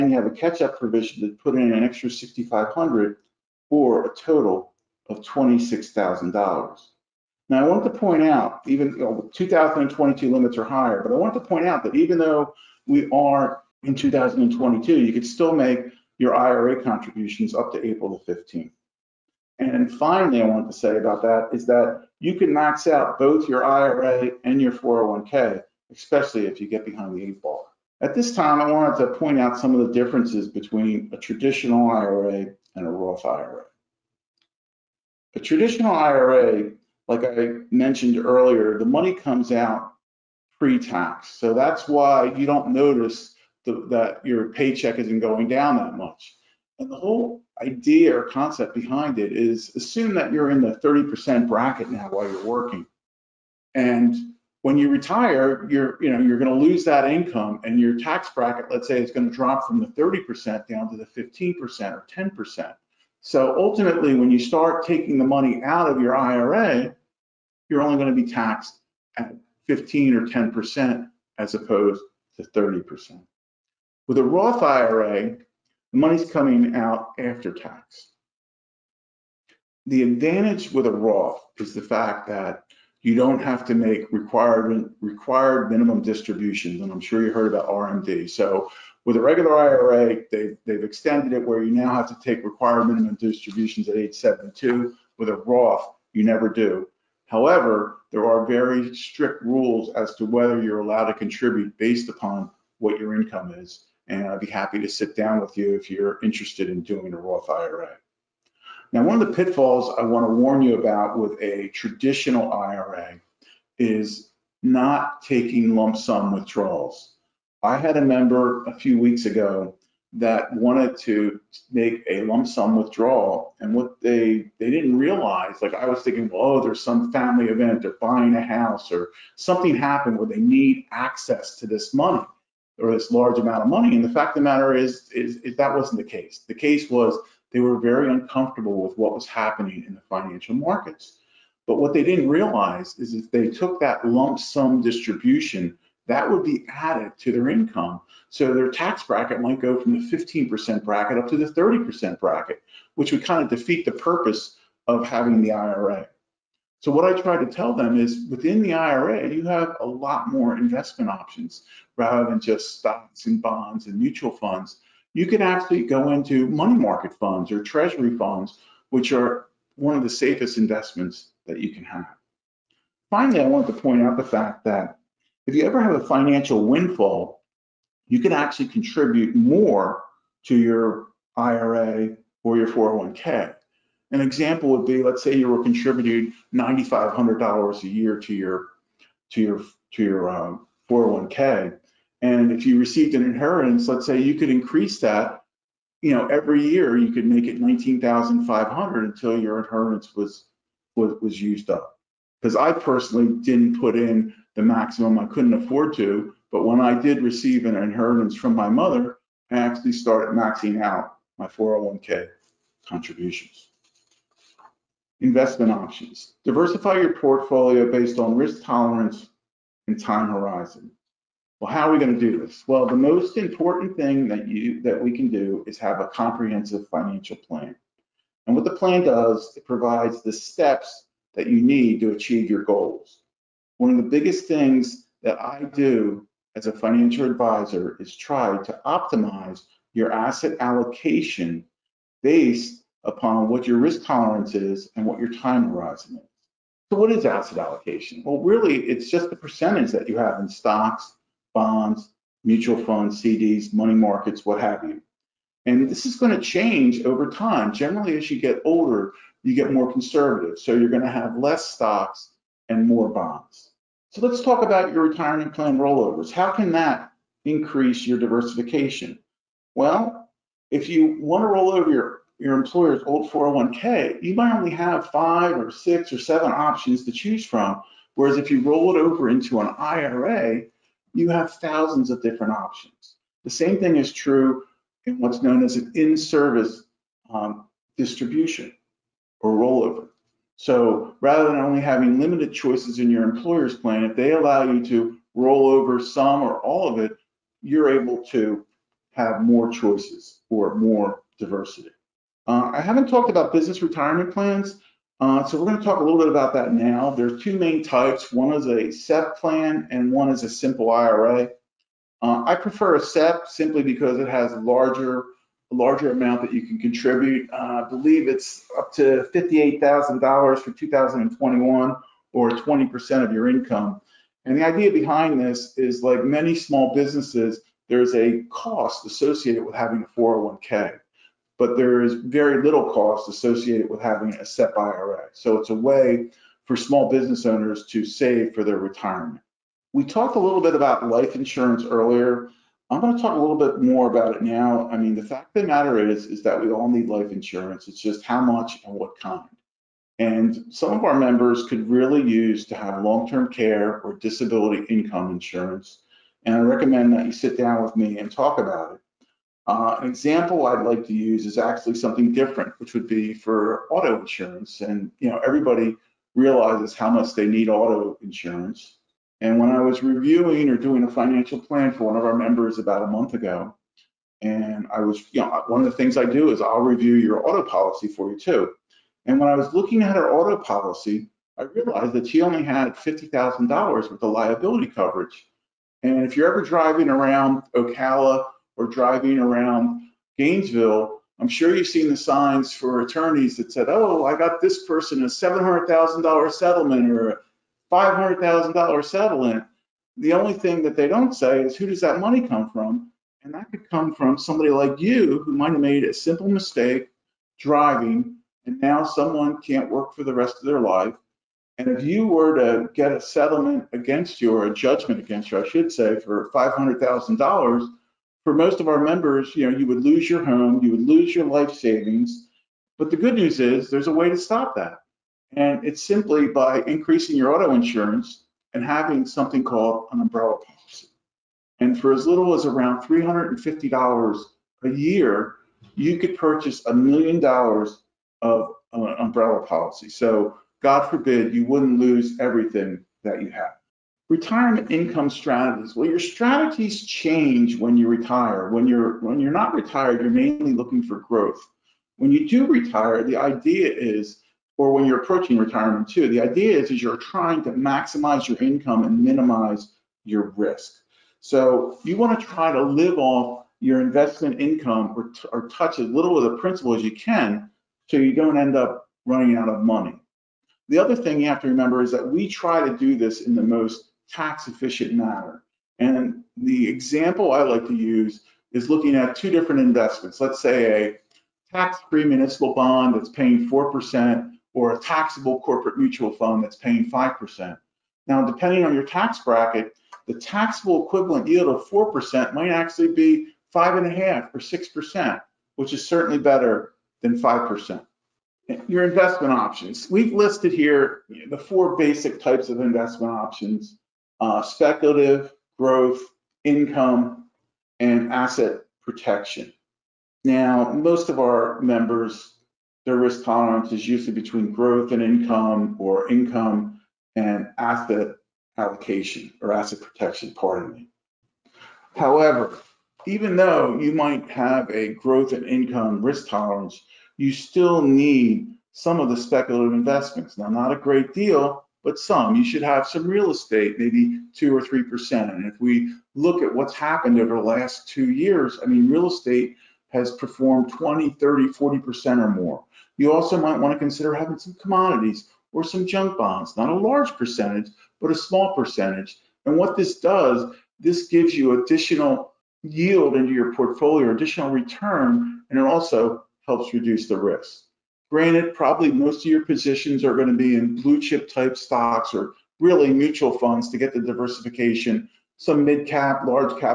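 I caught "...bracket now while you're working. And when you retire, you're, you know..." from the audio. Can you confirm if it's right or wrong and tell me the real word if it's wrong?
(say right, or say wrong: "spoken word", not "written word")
right.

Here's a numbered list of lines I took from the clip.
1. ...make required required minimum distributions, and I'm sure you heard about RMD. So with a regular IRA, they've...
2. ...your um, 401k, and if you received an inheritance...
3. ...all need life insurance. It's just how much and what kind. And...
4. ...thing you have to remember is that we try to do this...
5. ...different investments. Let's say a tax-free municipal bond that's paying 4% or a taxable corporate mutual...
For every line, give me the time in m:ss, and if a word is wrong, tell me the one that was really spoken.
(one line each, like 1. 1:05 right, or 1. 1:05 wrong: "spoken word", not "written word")
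1. 1:23 right
2. 3:10 right
3. 5:46 right
4. 7:51 right
5. 7:59 right.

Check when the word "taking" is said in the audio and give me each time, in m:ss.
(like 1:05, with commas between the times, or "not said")
1:04, 1:55.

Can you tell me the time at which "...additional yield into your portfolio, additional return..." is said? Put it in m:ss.
9:11.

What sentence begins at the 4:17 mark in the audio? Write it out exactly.
Generally, as you get older, you get more conservative.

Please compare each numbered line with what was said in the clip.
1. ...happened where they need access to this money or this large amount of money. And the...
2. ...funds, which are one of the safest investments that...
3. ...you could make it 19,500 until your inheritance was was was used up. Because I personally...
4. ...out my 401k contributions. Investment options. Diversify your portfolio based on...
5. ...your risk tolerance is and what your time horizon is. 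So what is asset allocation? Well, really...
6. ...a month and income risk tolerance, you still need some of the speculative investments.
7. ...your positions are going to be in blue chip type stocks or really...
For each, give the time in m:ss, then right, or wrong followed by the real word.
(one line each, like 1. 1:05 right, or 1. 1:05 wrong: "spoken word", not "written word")
1. 2:09 right
2. 2:48 right
3. 3:16 right
4. 3:30 right
5. 4:03 right
6. 8:44 wrong: "growth", not "month"
7. 9:19 right.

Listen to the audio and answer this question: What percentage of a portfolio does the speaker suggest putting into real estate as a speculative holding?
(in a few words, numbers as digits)
2 or 3 percent.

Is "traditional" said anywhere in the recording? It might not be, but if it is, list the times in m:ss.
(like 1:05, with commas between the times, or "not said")
0:31, 0:35, 1:51.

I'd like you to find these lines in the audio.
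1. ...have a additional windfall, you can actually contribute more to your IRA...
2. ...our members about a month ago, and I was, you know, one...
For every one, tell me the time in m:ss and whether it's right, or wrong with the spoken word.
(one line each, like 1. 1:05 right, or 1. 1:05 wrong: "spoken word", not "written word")
1. 2:55 wrong: "financial", not "additional"
2. 6:12 right.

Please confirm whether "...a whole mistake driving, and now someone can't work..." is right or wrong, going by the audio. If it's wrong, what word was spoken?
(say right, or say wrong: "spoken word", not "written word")
wrong: "simple", not "whole".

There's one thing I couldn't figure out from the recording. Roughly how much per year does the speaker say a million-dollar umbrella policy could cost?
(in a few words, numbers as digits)
$350.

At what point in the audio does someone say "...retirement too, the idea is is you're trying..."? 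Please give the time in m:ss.
7:35.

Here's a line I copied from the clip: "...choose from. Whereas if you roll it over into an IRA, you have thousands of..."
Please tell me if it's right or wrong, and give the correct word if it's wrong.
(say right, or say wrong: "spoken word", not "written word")
right.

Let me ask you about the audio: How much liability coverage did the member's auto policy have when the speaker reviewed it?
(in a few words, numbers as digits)
$50,000.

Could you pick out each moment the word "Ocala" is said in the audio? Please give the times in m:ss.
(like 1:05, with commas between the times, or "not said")
6:27.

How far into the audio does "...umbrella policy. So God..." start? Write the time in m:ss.
7:19.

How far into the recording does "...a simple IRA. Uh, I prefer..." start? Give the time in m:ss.
5:10.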